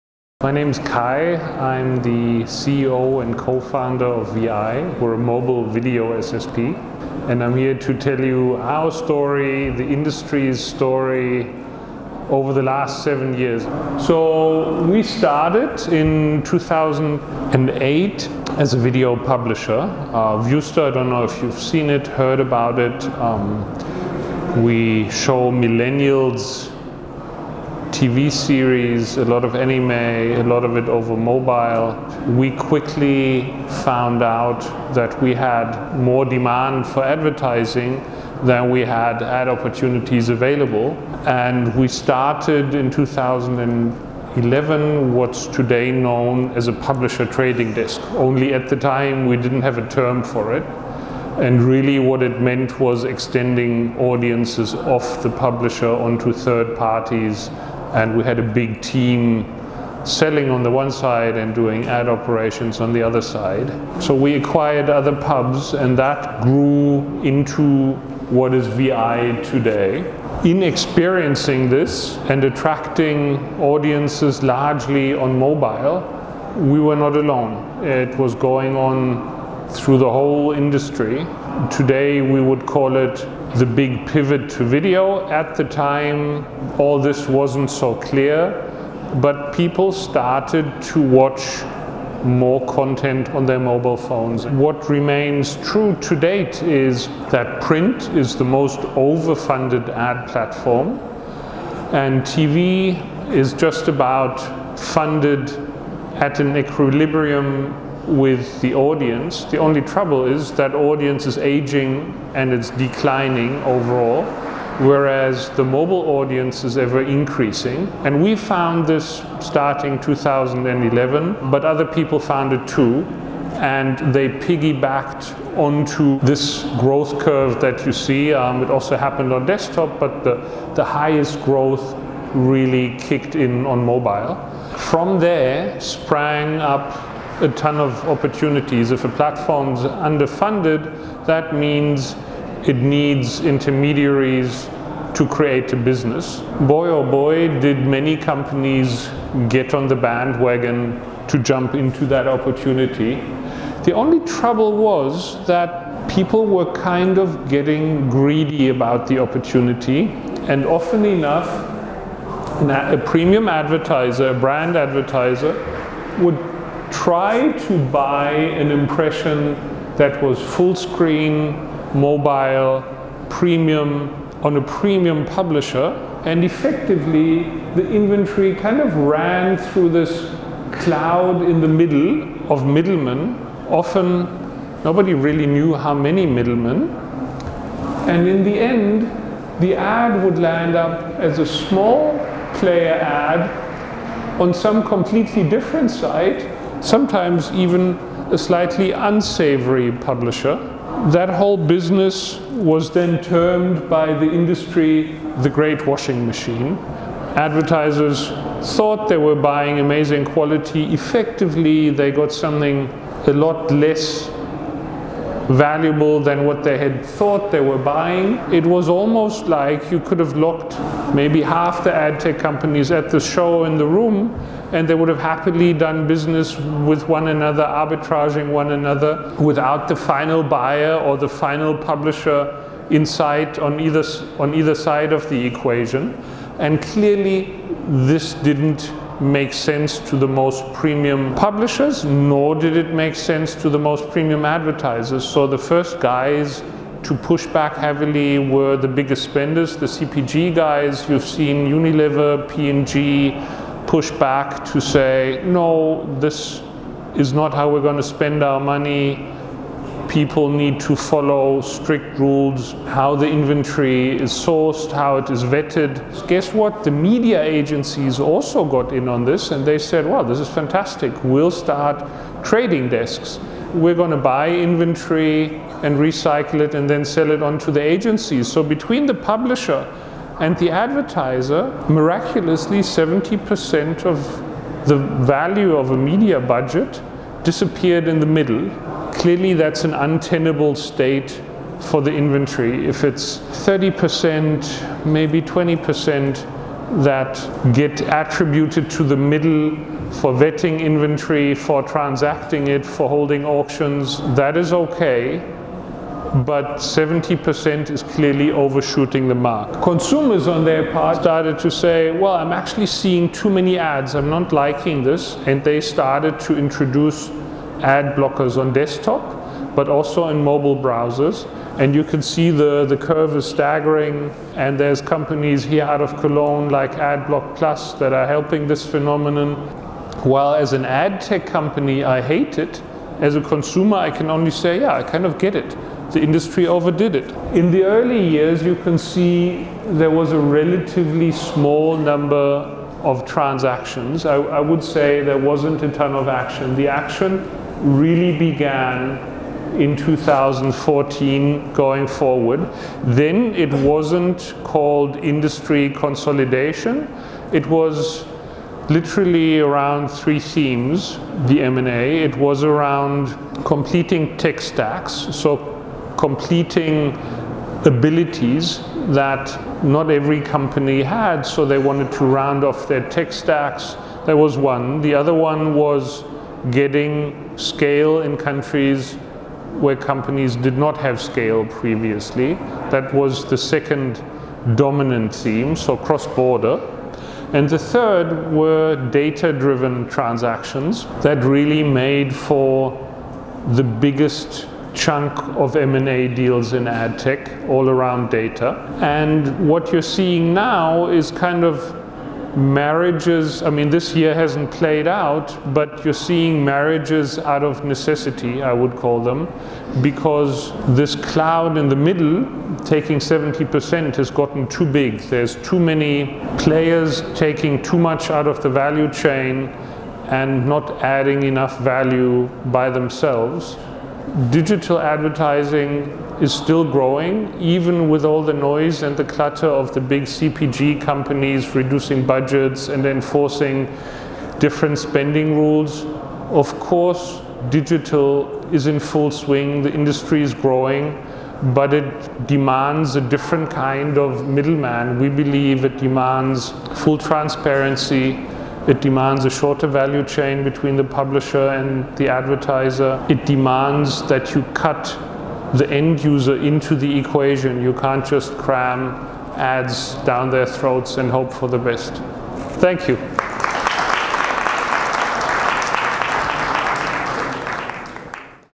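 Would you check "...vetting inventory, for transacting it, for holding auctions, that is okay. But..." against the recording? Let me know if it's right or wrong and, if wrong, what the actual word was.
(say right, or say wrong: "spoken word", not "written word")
right.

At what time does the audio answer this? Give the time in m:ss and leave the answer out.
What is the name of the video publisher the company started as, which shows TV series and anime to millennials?
0:20.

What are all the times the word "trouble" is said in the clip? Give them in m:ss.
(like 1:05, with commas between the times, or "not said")
1:49, 2:34.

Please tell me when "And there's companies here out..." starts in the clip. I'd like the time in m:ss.
5:24.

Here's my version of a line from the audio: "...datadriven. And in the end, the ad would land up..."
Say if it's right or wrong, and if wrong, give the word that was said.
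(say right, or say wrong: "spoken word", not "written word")
wrong: "middlemen", not "datadriven".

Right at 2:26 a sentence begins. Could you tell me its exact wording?
Boy oh boy, did many companies get on the bandwagon to jump into that opportunity.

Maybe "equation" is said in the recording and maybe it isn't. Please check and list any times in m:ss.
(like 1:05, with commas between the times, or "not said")
3:55, 7:37.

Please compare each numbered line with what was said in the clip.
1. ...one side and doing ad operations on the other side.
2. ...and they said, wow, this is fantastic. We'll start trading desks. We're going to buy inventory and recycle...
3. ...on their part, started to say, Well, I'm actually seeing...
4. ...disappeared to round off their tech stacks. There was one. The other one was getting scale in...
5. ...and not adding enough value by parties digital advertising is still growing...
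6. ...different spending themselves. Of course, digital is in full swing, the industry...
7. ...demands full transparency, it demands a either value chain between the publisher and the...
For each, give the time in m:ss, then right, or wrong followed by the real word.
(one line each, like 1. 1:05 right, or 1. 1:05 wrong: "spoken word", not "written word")
1. 1:00 right
2. 4:29 right
3. 5:10 right
4. 6:11 wrong: "wanted", not "disappeared"
5. 7:00 wrong: "themselves", not "parties"
6. 7:14 wrong: "rules", not "themselves"
7. 7:25 wrong: "shorter", not "either".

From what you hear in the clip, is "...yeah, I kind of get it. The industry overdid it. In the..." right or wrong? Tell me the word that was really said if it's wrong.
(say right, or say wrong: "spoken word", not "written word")
right.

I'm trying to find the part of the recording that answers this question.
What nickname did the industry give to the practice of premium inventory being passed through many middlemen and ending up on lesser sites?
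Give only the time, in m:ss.
3:25.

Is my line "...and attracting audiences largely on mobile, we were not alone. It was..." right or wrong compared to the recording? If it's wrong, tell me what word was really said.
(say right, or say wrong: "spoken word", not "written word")
right.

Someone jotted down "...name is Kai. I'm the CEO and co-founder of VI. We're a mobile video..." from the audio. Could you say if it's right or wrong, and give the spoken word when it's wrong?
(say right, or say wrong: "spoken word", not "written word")
right.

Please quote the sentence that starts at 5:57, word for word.
It was literally around three themes, the M&A.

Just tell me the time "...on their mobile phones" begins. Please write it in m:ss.
1:33.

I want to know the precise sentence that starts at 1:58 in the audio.
And we found this starting 2011, but other people found it too.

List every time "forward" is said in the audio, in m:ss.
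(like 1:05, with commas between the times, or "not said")
5:52.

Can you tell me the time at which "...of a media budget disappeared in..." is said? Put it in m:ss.
4:45.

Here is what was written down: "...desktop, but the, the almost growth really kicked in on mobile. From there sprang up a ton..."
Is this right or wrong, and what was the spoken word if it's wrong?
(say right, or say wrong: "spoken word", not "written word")
wrong: "highest", not "almost".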